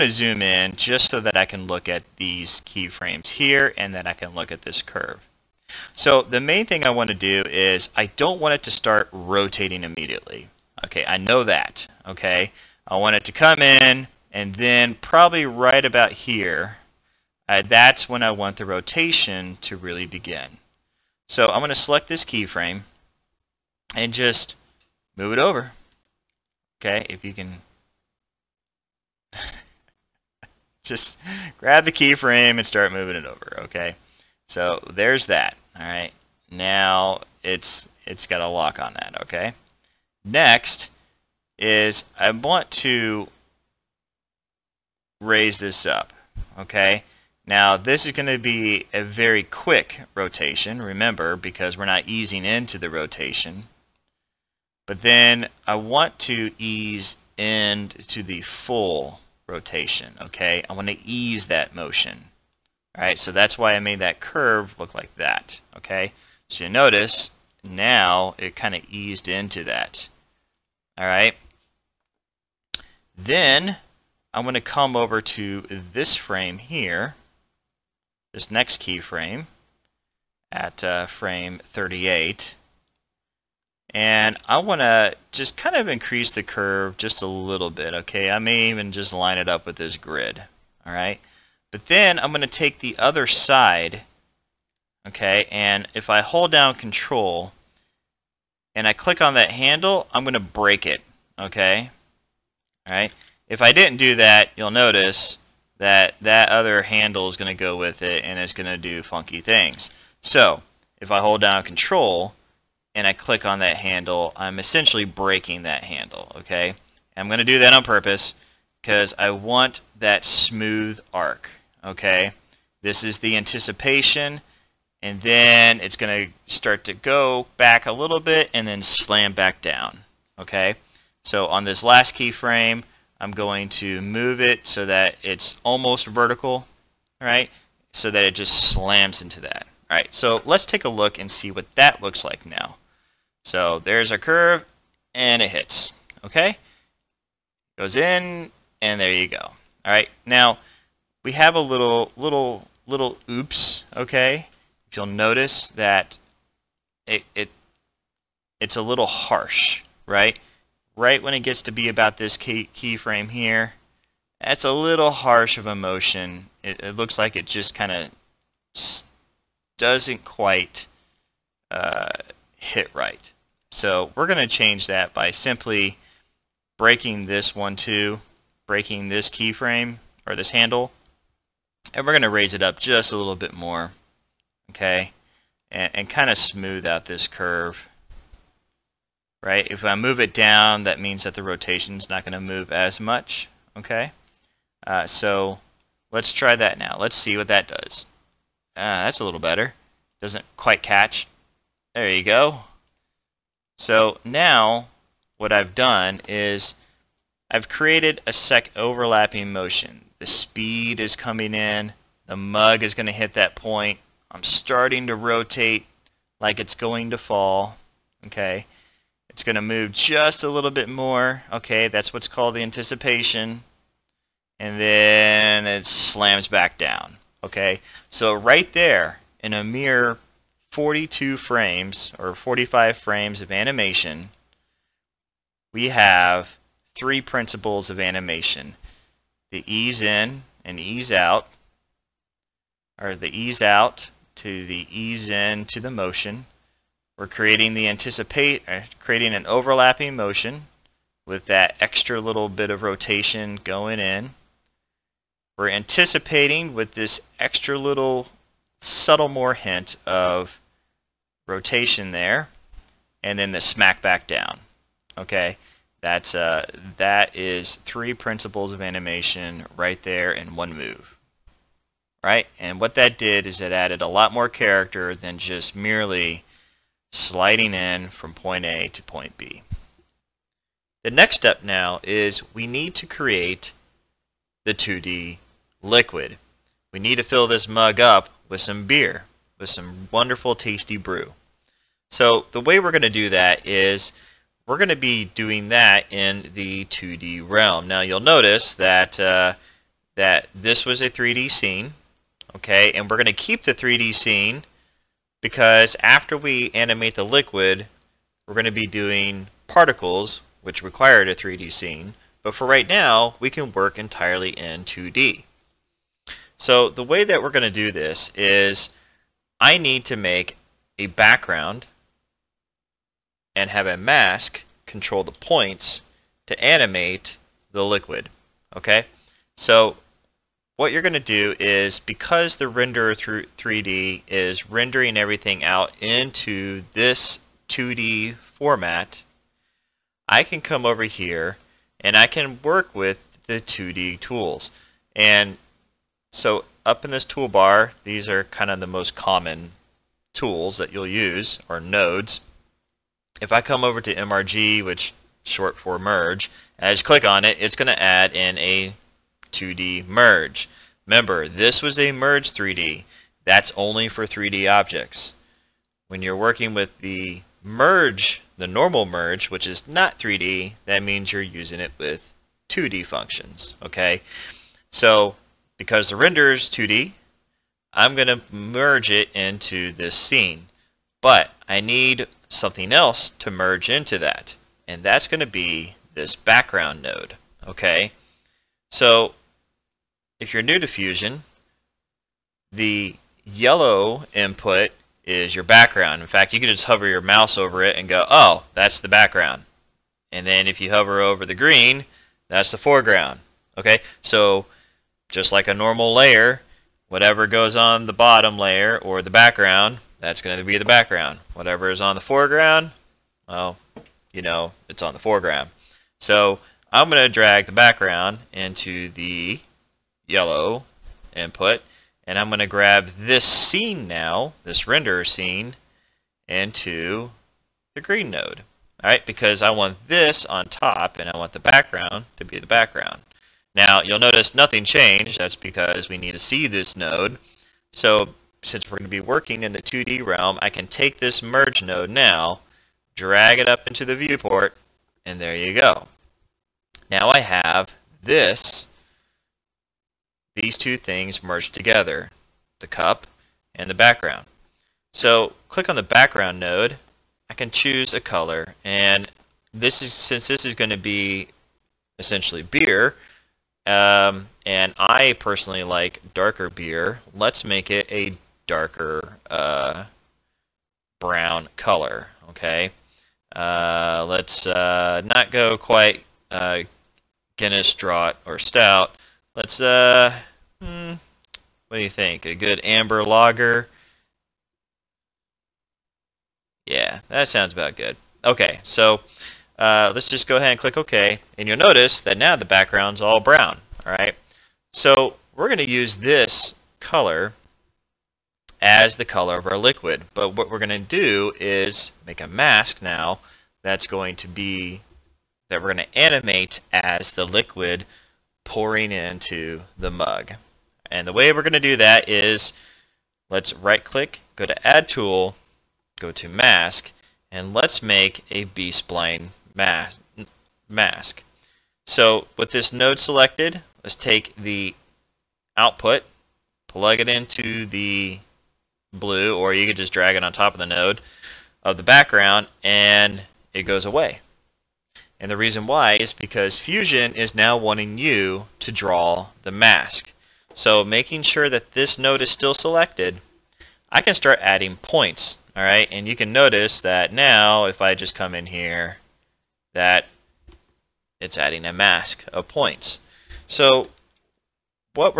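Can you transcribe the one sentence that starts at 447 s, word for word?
Now I have this, these two things merged together, the cup and the background.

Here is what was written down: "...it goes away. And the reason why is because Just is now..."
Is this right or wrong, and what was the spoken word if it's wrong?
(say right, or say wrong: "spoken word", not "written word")
wrong: "Fusion", not "Just".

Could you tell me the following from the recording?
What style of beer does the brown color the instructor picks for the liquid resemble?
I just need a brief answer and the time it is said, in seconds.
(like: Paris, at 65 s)
amber lager, at 482 s.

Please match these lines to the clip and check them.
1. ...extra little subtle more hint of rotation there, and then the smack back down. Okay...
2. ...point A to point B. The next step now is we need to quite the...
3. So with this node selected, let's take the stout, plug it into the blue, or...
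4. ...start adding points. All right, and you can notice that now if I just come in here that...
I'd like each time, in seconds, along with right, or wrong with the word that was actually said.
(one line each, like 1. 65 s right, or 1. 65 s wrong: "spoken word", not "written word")
1. 257 s right
2. 278 s wrong: "create", not "quite"
3. 522 s wrong: "output", not "stout"
4. 544 s right.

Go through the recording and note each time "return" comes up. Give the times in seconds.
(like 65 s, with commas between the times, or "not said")
not said.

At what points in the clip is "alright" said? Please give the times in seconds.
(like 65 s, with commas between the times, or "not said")
90 s, 102 s, 429 s.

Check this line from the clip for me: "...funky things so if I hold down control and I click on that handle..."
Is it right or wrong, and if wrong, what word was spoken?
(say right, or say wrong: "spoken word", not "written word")
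right.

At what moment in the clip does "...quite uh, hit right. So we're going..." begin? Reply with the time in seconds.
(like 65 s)
170 s.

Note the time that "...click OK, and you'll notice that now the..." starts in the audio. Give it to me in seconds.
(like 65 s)
490 s.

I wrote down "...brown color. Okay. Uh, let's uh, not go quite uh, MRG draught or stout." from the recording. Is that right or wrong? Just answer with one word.
wrong.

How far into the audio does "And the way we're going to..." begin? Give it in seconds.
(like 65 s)
511 s.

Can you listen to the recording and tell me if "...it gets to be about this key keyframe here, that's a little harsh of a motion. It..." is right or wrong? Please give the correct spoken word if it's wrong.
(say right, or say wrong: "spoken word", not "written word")
right.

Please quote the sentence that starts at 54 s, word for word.
But then I want to ease into the full rotation, okay?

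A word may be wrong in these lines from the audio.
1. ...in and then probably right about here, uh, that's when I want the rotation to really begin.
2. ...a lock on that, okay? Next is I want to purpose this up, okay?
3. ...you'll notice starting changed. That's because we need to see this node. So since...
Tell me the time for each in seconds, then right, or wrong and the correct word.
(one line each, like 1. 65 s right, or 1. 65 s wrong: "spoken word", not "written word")
1. 13 s right
2. 38 s wrong: "raise", not "purpose"
3. 434 s wrong: "nothing", not "starting".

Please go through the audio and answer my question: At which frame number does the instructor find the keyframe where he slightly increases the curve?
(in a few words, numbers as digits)
38.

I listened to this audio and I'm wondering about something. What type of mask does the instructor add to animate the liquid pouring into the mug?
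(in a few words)
B-spline mask.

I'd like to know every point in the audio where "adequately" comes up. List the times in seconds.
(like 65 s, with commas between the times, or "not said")
not said.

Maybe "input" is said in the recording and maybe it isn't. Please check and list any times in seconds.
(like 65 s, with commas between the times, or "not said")
394 s, 421 s.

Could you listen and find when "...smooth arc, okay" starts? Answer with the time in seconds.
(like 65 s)
120 s.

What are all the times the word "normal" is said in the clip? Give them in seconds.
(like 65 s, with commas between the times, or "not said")
368 s, 405 s.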